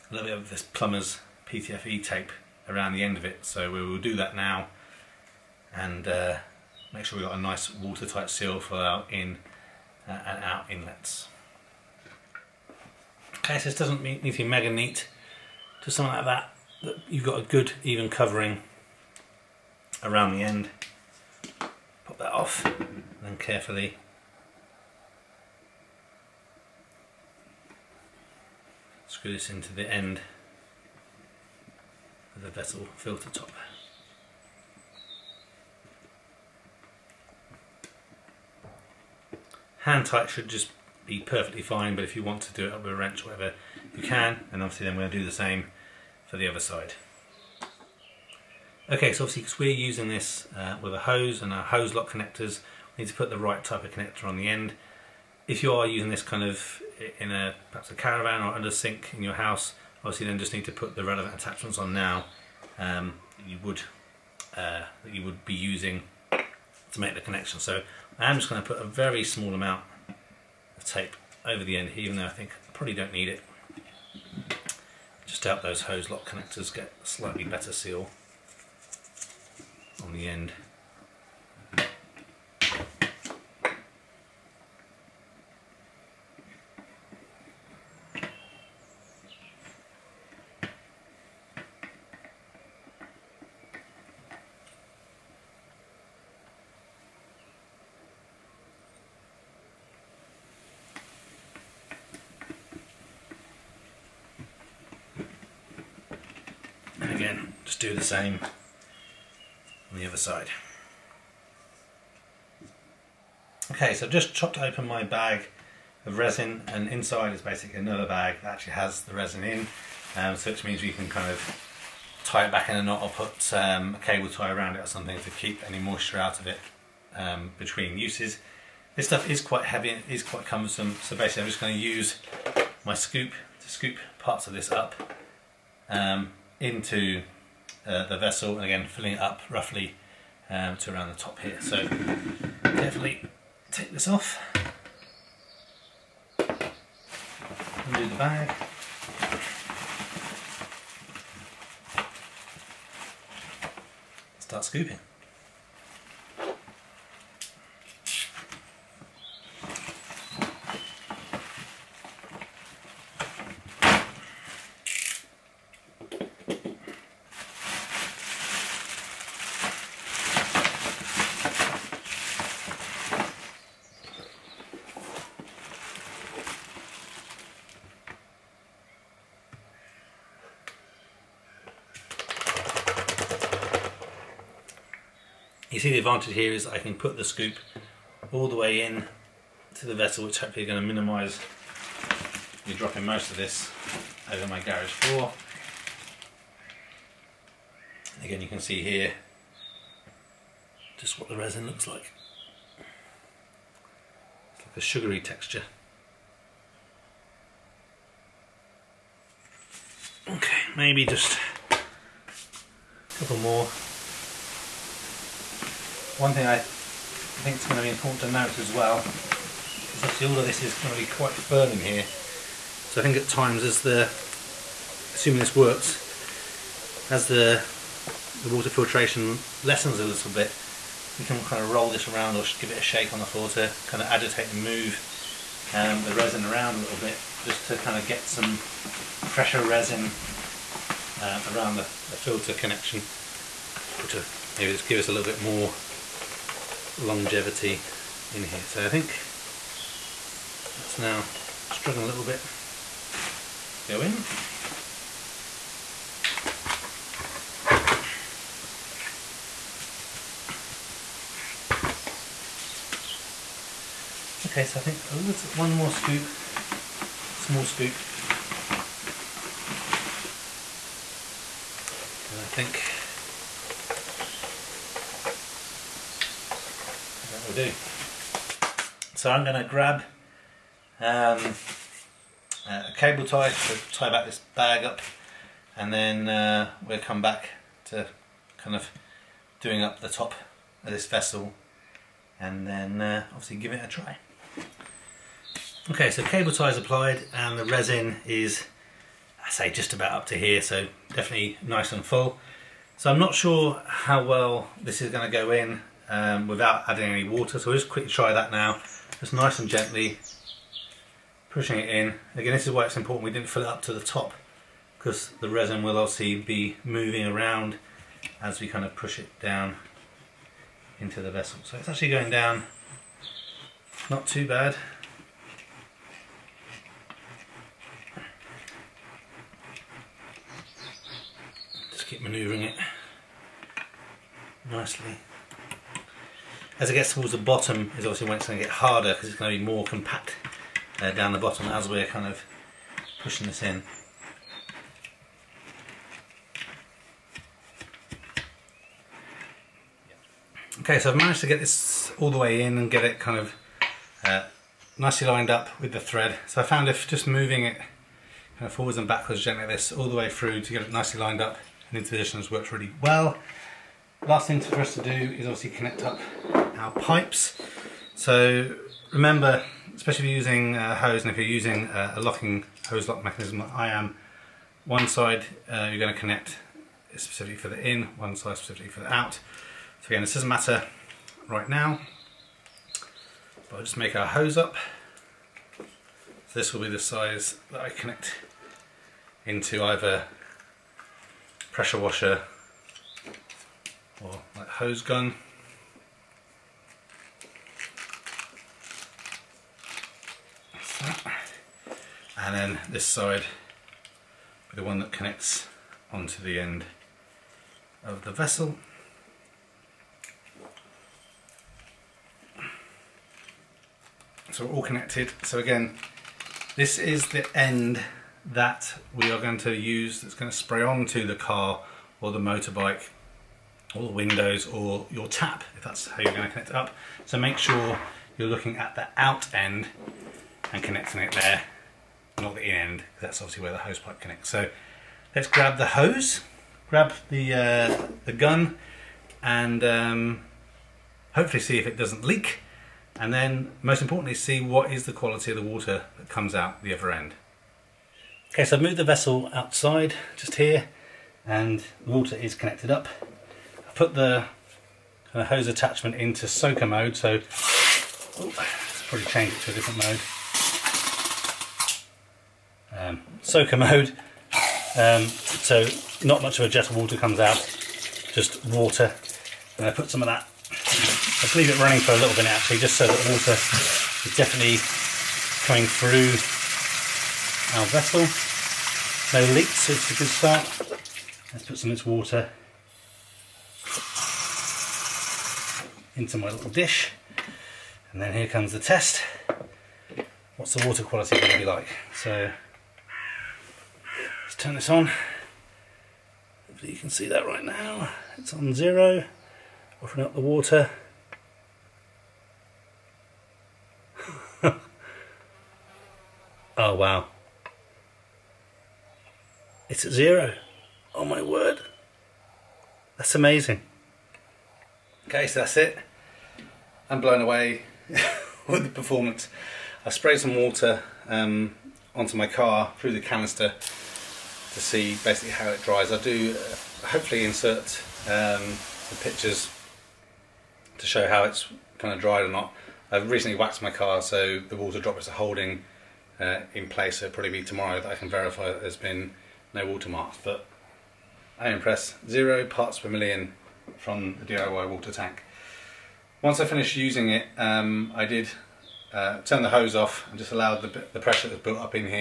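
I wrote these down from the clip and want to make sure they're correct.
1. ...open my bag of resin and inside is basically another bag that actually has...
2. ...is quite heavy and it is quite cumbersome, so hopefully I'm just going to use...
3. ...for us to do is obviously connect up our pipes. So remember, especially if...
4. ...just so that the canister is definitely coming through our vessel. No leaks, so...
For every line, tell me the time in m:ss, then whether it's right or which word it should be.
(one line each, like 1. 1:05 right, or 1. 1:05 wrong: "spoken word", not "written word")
1. 1:54 right
2. 2:09 wrong: "basically", not "hopefully"
3. 6:04 right
4. 7:52 wrong: "water", not "canister".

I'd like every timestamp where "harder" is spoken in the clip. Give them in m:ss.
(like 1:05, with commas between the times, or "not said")
5:38.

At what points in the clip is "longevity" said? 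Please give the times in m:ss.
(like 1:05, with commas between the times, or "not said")
4:06.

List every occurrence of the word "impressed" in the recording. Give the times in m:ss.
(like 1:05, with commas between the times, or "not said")
9:01.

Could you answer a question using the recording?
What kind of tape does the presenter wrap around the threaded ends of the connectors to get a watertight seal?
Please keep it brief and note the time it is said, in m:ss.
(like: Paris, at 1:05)
PTFE tape, at 0:01.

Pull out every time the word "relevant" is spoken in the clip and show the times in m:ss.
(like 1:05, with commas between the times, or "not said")
1:01.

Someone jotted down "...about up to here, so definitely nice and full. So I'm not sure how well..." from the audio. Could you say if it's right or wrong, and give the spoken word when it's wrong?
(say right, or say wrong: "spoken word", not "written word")
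right.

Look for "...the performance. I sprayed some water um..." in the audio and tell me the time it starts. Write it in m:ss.
8:38.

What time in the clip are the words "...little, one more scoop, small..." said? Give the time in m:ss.
4:25.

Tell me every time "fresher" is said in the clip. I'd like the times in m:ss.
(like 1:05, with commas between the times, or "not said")
3:58.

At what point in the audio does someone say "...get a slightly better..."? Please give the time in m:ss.
1:16.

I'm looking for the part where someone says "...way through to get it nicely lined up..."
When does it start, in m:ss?
6:00.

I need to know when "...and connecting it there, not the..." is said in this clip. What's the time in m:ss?
7:10.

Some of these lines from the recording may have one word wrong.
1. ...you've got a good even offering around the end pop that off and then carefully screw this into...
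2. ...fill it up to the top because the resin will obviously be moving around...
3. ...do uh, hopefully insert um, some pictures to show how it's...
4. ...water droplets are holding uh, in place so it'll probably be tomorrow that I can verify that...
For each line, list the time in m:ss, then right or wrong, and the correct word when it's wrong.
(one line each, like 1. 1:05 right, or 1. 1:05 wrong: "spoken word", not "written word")
1. 0:17 wrong: "covering", not "offering"
2. 5:13 right
3. 8:46 right
4. 8:54 right.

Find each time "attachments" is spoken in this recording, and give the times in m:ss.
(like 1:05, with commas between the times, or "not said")
1:01, 7:35.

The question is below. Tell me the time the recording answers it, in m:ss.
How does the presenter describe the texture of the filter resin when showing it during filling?
3:24.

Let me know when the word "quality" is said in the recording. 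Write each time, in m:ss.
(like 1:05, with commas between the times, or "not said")
7:25, 8:11.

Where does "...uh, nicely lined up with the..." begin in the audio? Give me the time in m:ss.
5:54.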